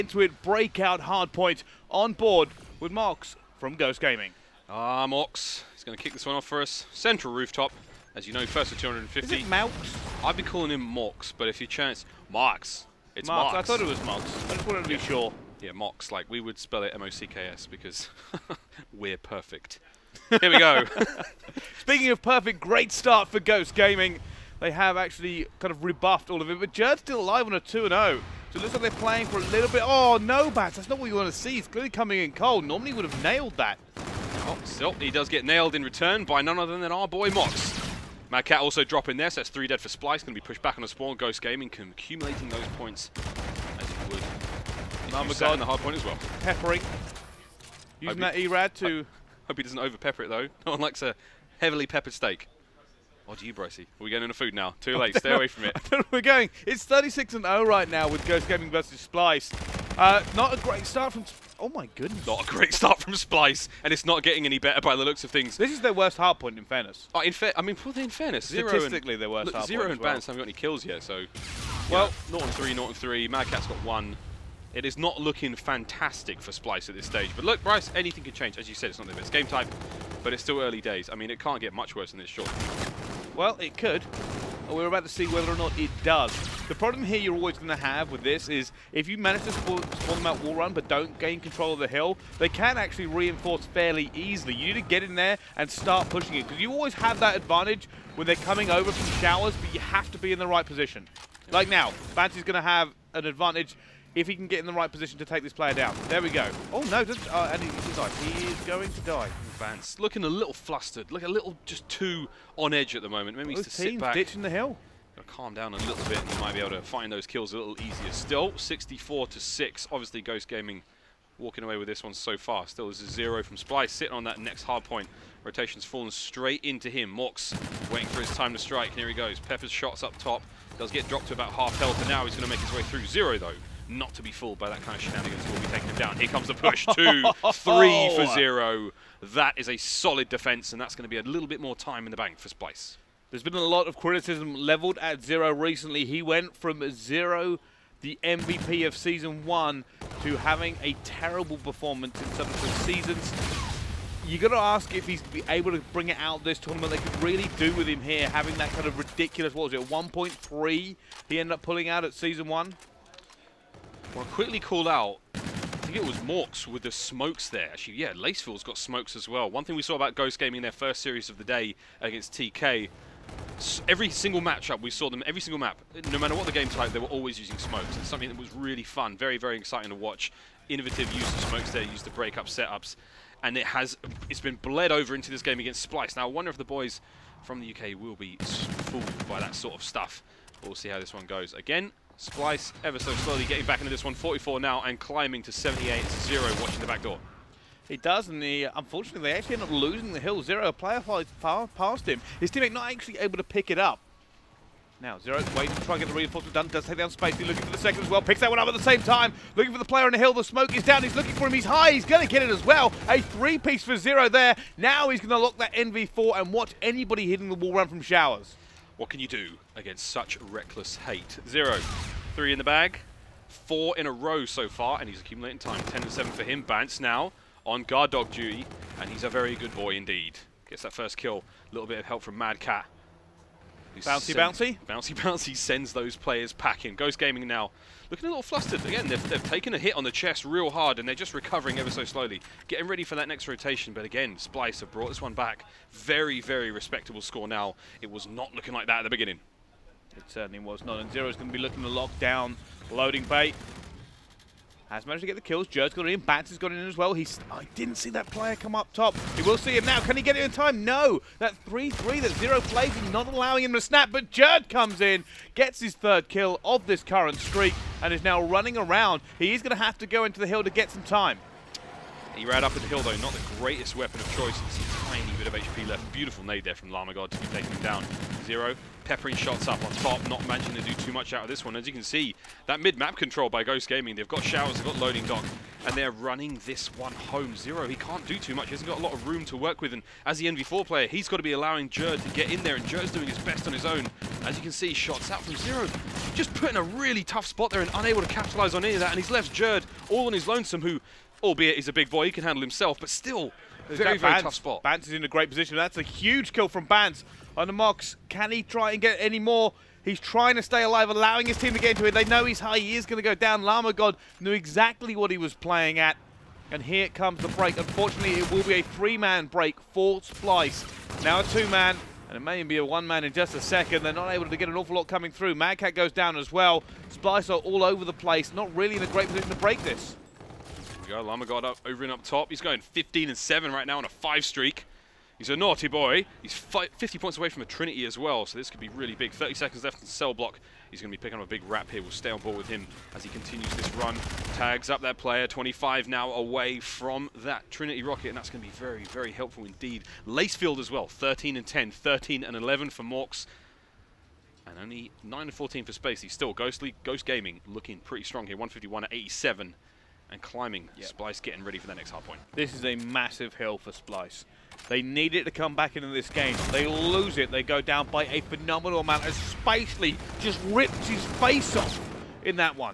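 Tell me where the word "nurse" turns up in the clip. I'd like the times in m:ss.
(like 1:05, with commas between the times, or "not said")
not said.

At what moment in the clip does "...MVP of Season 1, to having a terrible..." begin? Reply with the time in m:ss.
2:28.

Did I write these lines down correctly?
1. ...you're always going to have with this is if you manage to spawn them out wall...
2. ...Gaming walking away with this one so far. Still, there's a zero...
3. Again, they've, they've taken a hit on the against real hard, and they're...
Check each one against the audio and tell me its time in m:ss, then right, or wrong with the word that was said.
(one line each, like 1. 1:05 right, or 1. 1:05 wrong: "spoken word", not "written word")
1. 1:27 right
2. 2:00 right
3. 3:58 wrong: "chest", not "against".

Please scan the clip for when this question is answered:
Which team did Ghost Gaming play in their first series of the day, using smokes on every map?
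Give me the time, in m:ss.
2:52.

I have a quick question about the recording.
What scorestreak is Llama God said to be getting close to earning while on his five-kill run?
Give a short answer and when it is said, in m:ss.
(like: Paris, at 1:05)
Trinity rocket, at 5:47.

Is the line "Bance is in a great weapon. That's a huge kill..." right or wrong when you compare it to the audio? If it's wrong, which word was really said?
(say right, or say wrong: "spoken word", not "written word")
wrong: "position", not "weapon".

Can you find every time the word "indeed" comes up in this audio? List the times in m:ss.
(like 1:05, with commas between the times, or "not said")
3:49, 5:49.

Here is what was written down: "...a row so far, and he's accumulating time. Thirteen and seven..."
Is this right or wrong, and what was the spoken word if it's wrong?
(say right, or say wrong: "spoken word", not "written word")
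wrong: "Ten", not "Thirteen".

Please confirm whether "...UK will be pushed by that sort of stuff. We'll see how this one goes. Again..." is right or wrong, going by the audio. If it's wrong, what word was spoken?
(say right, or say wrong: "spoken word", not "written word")
wrong: "fooled", not "pushed".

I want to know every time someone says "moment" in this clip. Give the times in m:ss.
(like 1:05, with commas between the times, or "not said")
1:53.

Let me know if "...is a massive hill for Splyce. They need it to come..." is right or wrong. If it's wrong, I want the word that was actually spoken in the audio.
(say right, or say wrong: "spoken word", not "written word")
right.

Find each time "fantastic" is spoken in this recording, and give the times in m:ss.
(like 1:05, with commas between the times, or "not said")
1:15.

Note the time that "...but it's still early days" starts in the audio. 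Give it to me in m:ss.
1:20.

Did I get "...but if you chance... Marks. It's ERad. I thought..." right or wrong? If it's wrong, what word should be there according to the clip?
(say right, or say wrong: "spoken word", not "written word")
wrong: "Marks", not "ERad".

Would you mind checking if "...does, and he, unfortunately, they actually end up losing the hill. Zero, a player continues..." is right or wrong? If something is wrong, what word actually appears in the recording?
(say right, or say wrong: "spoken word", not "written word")
wrong: "flies", not "continues".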